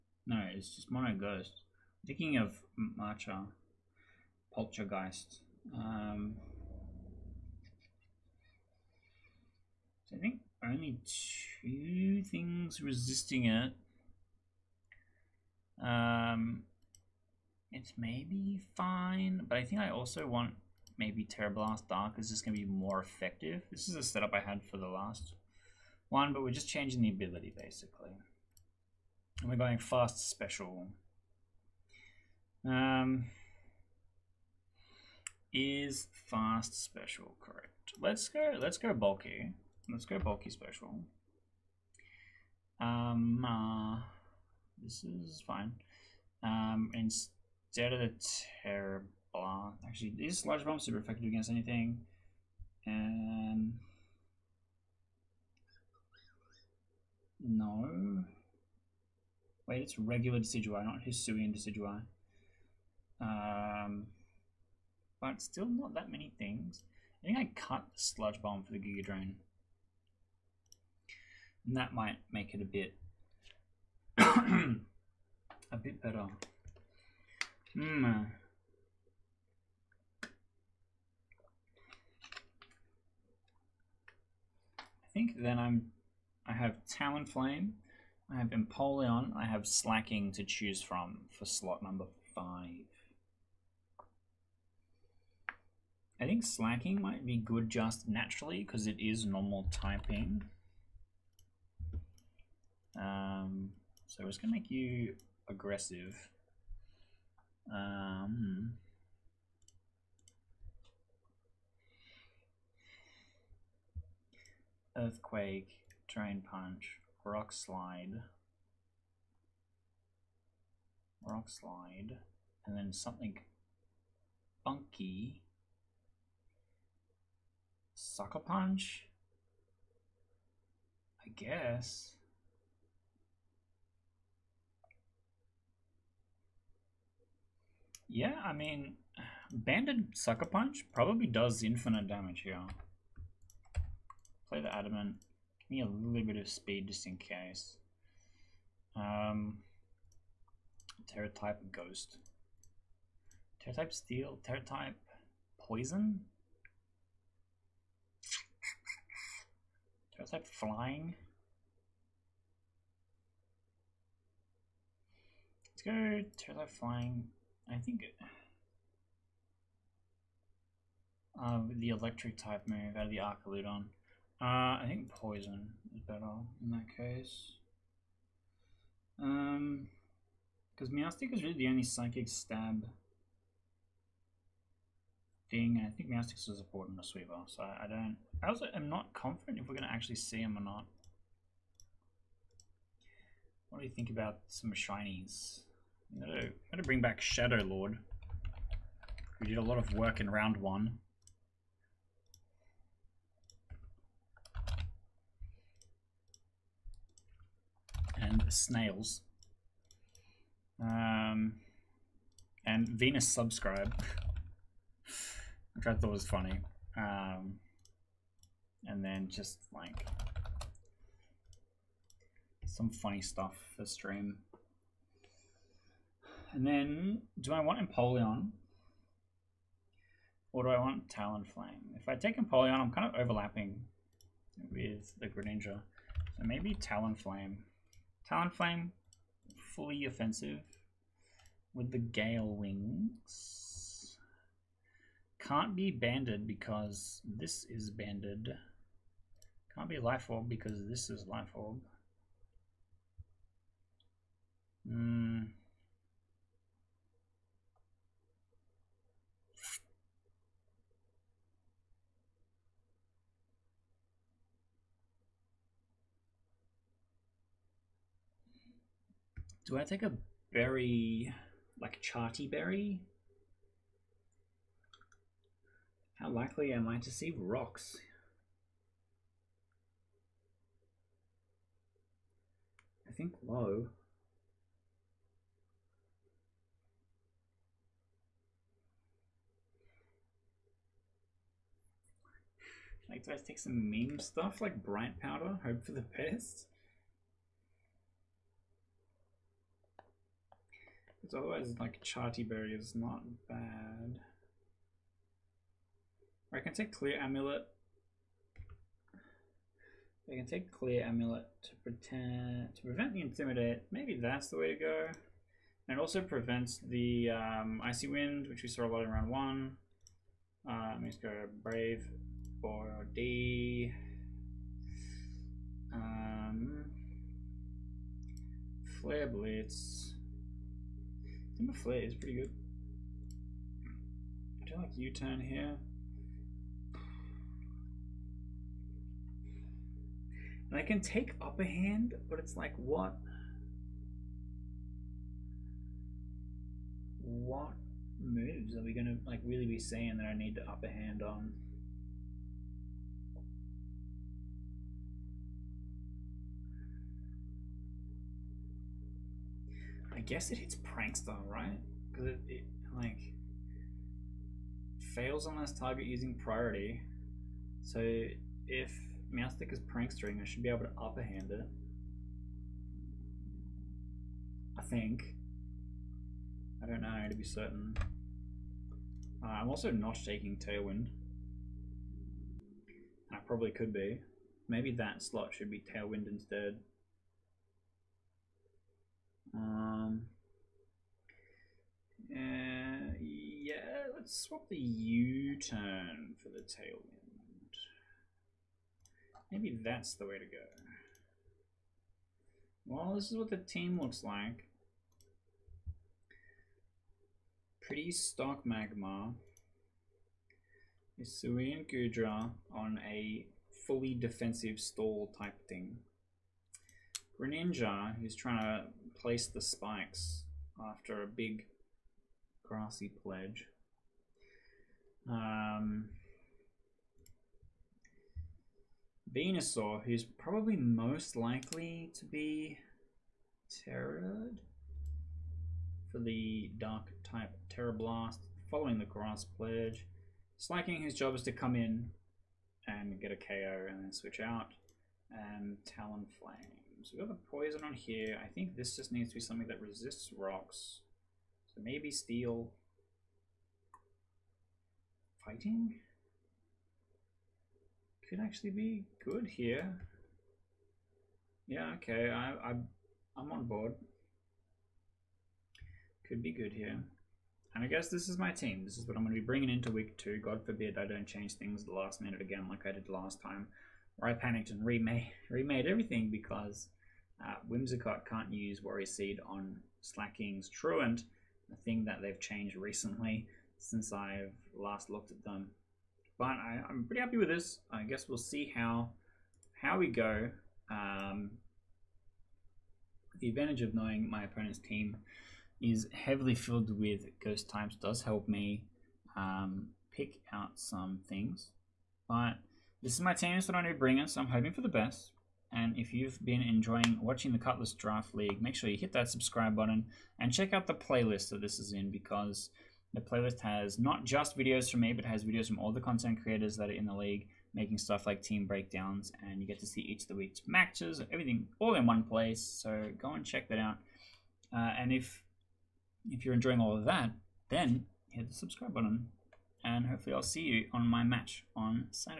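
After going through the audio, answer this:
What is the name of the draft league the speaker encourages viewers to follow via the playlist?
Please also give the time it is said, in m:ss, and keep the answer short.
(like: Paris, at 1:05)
Cutlass Draft League, at 8:27.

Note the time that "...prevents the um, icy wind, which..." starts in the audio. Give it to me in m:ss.
5:16.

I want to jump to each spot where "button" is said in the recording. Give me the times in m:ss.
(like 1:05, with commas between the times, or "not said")
8:29, 8:48.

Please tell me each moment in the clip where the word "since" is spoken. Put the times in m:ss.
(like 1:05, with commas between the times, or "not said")
8:03.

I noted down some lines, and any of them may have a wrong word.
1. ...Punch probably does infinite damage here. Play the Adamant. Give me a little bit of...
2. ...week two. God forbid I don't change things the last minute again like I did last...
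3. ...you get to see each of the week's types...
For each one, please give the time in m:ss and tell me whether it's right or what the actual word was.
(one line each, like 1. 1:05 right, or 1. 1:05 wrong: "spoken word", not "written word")
1. 2:20 right
2. 7:49 right
3. 8:39 wrong: "matches", not "types".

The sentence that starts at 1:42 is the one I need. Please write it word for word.
Um, so it's going to make you aggressive.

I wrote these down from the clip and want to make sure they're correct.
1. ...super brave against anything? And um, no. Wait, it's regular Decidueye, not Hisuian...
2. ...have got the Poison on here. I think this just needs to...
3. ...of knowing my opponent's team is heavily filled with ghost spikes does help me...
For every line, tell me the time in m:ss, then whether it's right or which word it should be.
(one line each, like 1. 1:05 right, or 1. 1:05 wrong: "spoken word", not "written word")
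1. 0:50 wrong: "effective", not "brave"
2. 7:27 right
3. 8:13 wrong: "types", not "spikes".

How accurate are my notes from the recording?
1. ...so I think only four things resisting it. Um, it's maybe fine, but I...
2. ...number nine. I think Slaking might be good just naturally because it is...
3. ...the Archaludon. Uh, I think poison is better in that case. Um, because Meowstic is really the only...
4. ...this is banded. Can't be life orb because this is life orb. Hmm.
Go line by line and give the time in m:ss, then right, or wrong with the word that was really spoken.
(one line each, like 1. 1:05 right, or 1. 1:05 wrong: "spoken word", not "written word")
1. 0:10 wrong: "two", not "four"
2. 1:31 wrong: "five", not "nine"
3. 2:53 right
4. 4:07 right.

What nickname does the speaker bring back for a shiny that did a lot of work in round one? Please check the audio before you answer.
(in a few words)
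Shadow Lord.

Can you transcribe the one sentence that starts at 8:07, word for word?
I guess we'll see how how we go.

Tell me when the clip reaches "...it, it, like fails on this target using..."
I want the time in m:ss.
6:02.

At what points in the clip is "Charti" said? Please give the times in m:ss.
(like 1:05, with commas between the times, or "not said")
4:32, 5:02.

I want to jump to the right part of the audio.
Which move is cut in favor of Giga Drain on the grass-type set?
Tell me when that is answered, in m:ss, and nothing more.
1:07.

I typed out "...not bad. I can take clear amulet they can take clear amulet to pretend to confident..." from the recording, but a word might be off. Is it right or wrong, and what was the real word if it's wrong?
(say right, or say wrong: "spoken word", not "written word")
wrong: "prevent", not "confident".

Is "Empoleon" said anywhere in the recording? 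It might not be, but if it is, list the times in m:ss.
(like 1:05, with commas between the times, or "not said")
1:28, 3:47, 3:52.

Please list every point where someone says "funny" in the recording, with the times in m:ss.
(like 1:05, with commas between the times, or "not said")
3:36, 3:42.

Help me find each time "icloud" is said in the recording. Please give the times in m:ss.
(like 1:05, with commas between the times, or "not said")
not said.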